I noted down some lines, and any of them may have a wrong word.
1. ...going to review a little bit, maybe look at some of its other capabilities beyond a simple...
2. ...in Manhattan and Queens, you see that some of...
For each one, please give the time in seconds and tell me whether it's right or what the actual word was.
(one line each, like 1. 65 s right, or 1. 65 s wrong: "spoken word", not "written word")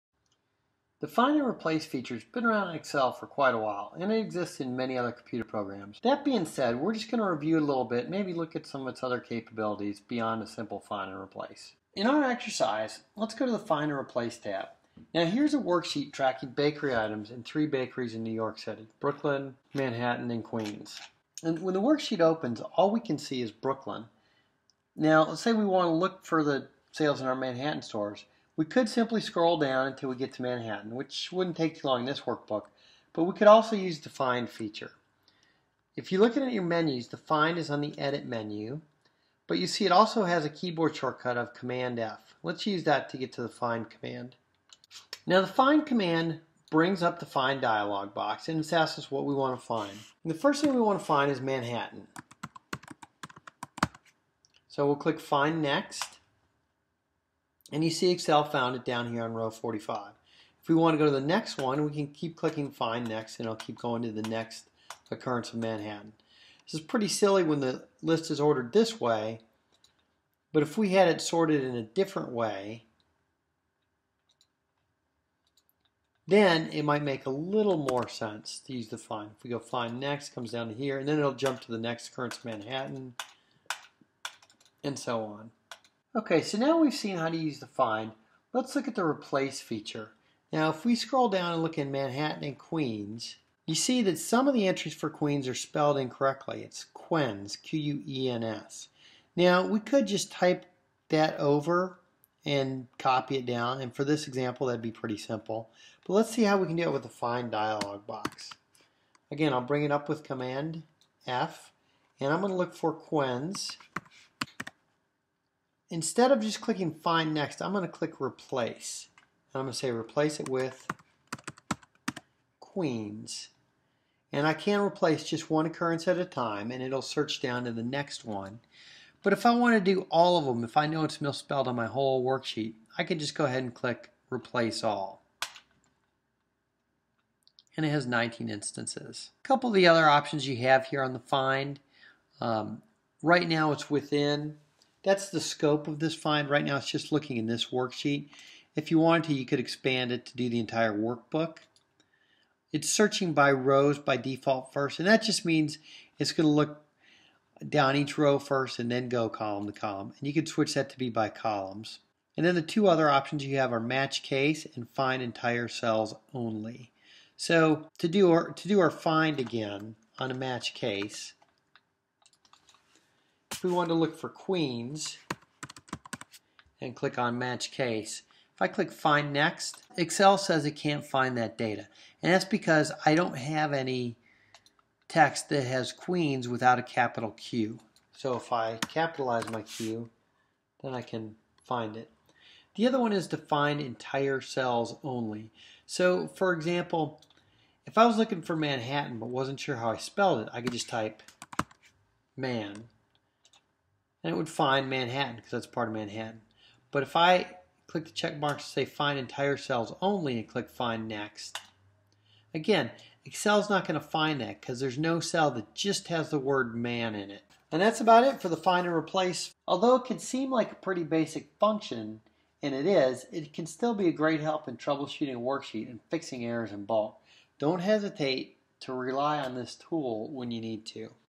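1. 7 s right
2. 91 s right.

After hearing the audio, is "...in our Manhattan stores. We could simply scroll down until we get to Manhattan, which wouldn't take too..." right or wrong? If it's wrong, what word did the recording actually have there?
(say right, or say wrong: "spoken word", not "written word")
right.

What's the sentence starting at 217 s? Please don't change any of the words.
And that's about it for the find and replace.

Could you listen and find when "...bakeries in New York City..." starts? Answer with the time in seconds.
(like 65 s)
17 s.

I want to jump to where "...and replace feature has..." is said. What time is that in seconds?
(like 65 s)
1 s.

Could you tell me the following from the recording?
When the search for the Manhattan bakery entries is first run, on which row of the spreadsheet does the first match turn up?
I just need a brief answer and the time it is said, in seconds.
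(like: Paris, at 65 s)
45, at 59 s.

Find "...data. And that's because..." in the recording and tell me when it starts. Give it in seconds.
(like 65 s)
181 s.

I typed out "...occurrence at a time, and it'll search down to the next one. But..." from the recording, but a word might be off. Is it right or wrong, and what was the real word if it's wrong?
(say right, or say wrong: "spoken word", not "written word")
right.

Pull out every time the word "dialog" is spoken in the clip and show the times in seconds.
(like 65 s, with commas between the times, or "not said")
47 s, 107 s.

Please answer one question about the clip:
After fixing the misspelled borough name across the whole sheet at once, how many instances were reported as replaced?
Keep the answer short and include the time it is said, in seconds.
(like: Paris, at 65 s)
19, at 138 s.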